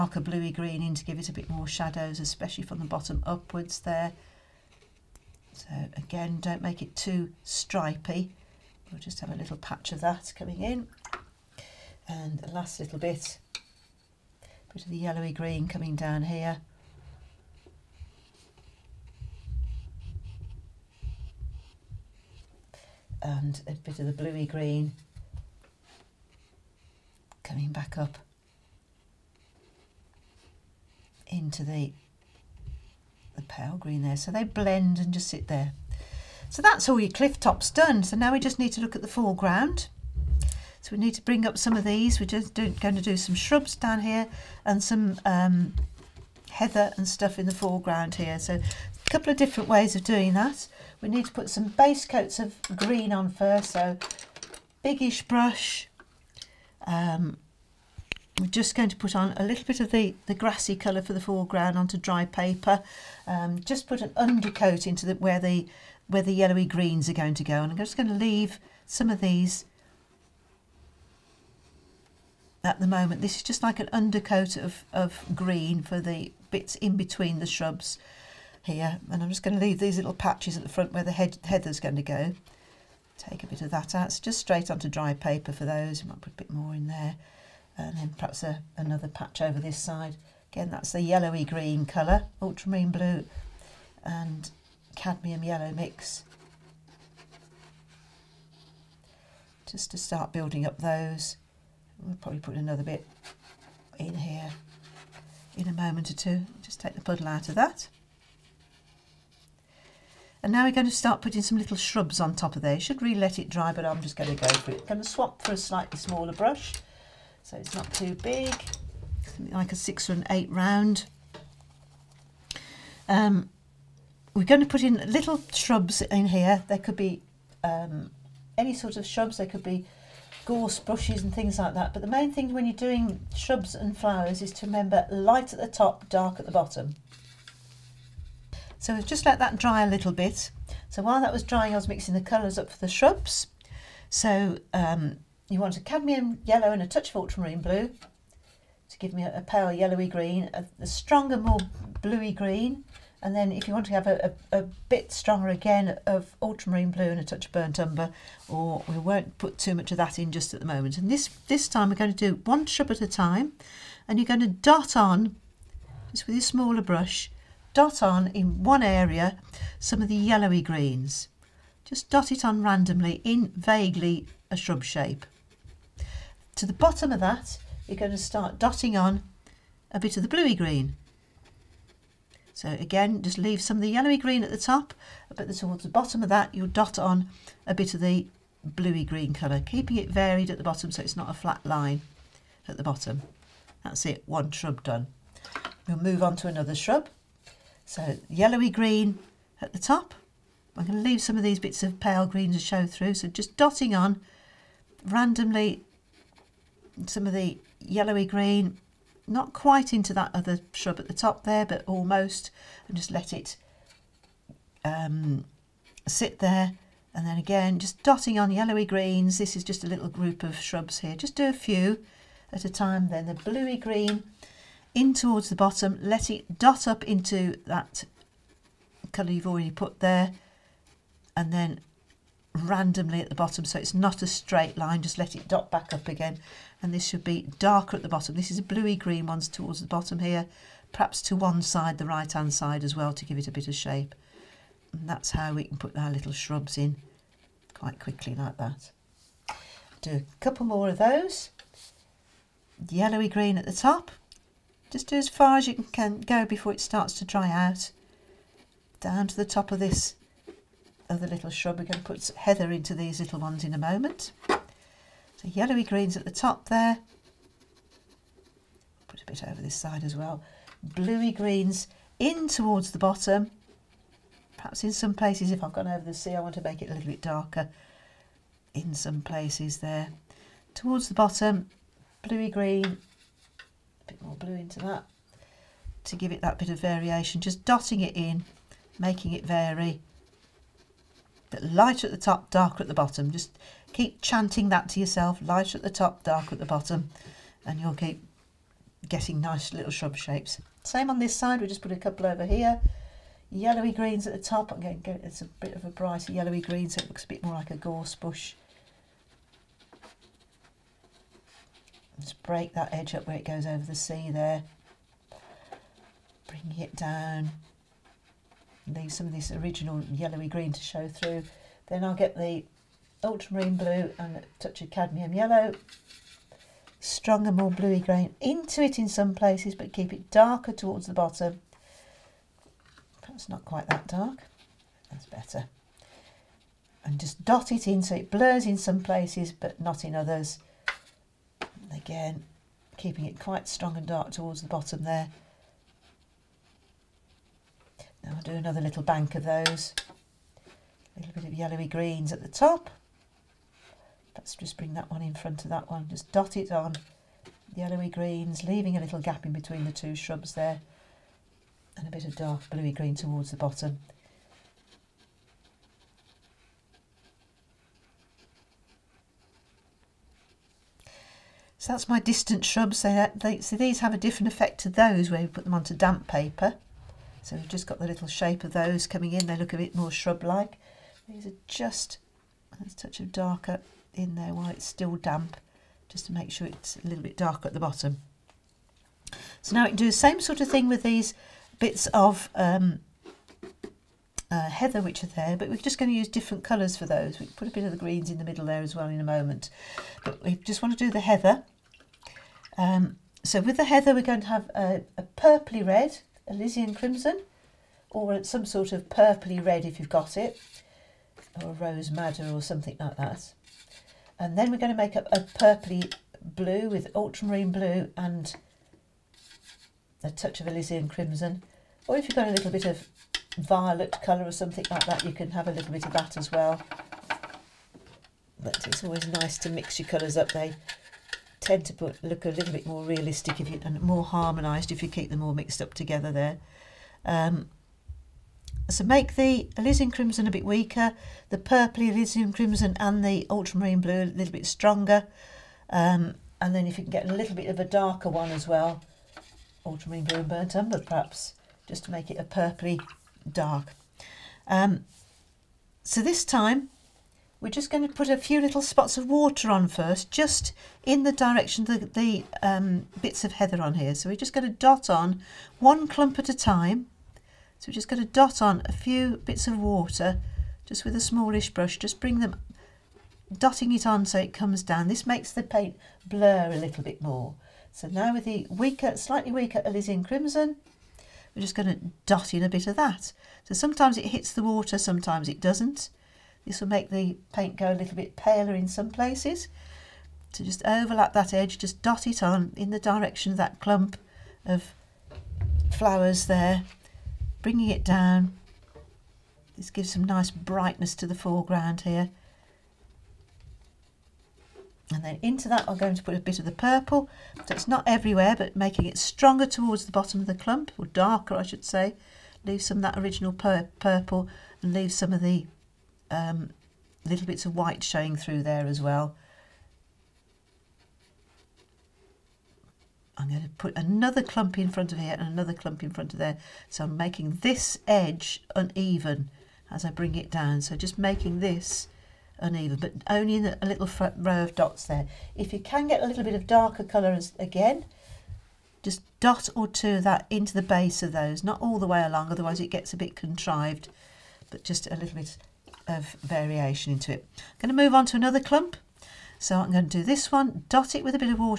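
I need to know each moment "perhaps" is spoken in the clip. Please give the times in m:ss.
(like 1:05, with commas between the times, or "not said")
1:28, 4:00, 4:34, 5:33, 7:30.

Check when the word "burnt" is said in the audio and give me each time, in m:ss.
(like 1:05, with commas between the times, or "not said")
2:37, 7:30.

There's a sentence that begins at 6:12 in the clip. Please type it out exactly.
So, that, they, so these have a different effect to those where we put them onto damp paper.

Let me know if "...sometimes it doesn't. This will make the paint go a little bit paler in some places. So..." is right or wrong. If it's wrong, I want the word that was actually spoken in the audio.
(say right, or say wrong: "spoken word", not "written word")
right.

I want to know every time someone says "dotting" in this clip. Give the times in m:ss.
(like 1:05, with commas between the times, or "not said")
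2:58, 3:23, 3:38, 4:47, 7:53.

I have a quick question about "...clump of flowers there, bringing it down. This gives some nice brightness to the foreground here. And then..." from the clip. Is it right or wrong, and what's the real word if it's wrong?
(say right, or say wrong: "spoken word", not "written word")
right.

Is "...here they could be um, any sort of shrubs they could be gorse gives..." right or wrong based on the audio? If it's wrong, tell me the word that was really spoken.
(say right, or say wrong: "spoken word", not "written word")
wrong: "bushes", not "gives".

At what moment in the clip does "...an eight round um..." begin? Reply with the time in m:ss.
2:00.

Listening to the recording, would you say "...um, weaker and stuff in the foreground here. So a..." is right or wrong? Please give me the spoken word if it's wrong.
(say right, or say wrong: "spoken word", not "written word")
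wrong: "heather", not "weaker".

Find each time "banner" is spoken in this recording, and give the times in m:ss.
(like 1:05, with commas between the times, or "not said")
not said.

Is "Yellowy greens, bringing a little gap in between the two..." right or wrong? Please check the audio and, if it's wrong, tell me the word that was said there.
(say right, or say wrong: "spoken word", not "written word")
wrong: "leaving", not "bringing".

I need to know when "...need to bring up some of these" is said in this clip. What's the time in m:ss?
0:40.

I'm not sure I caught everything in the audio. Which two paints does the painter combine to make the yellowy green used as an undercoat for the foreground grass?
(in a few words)
ultramarine blue and cadmium yellow.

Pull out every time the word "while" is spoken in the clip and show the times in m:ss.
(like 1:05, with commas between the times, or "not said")
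2:21, 6:24.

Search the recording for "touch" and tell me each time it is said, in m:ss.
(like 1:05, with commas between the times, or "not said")
2:26, 2:37, 5:24, 6:22, 7:00.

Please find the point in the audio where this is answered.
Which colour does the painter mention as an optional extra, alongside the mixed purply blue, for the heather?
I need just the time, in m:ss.
7:03.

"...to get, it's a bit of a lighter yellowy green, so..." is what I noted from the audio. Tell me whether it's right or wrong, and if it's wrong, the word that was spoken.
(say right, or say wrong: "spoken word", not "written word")
wrong: "brighter", not "lighter".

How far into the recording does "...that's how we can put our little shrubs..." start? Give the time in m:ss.
4:05.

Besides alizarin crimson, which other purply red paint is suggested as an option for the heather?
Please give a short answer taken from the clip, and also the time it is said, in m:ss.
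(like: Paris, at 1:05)
Rose Madder, at 6:51.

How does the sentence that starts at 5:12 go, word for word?
Just break that edge up where it goes over the sea there.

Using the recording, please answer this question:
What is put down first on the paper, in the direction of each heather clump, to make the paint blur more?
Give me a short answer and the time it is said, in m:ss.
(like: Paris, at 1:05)
spots of water, at 7:38.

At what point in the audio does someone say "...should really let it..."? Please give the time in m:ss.
1:52.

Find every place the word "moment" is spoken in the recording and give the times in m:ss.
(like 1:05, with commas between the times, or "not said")
1:12, 1:45, 2:40, 4:23, 6:39.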